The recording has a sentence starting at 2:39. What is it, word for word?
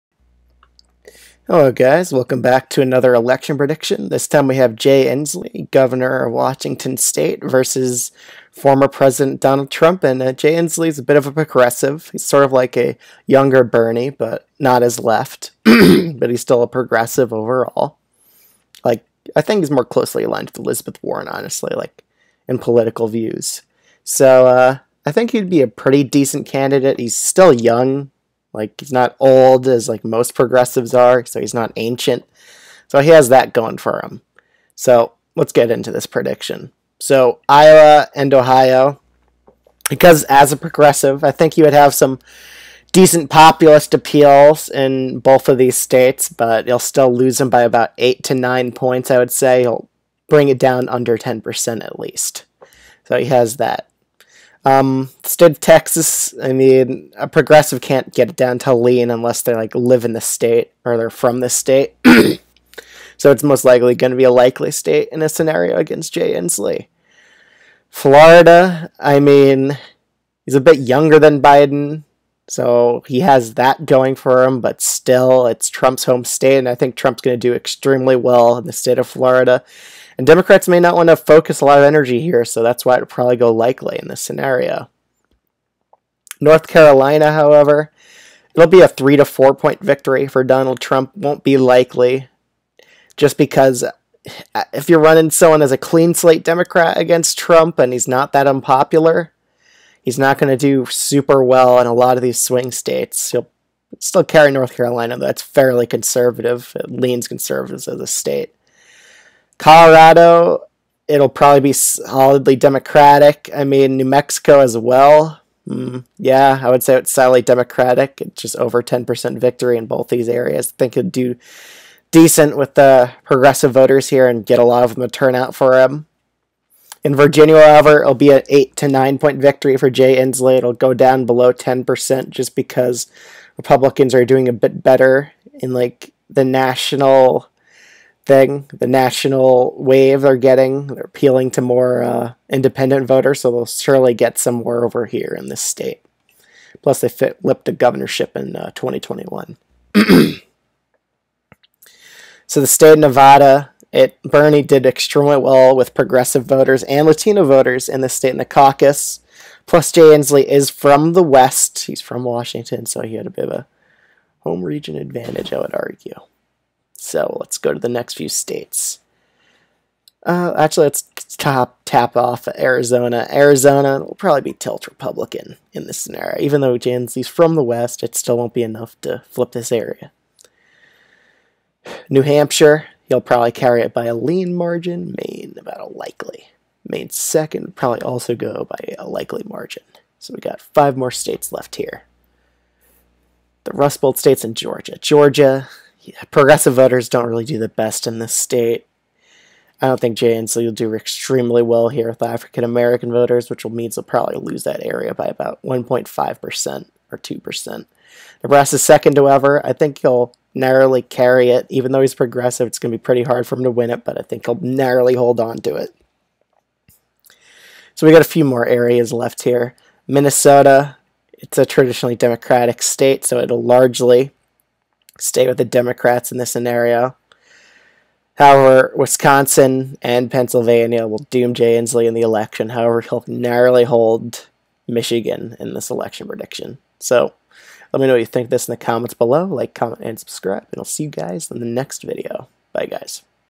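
Plus, Jay Inslee is from the West.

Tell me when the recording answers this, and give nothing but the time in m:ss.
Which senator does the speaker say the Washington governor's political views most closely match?
0:20.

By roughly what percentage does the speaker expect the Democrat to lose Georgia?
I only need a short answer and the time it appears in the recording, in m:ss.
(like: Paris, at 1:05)
1.5% or 2%, at 3:25.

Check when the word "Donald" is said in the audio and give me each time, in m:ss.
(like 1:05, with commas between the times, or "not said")
0:09, 1:30.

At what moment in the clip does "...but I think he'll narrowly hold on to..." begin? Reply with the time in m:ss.
3:34.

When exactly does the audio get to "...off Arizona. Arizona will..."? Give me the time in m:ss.
2:52.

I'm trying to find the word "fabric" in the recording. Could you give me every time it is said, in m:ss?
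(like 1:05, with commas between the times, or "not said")
not said.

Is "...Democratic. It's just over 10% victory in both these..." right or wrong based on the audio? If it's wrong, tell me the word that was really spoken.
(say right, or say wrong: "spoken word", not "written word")
right.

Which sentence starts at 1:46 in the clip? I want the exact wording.
It leans conservatives as a state.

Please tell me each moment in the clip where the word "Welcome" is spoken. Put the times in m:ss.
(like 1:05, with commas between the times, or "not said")
0:02.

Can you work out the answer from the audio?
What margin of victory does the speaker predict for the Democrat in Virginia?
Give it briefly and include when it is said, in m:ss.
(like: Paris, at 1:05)
8 to 9 points, at 2:08.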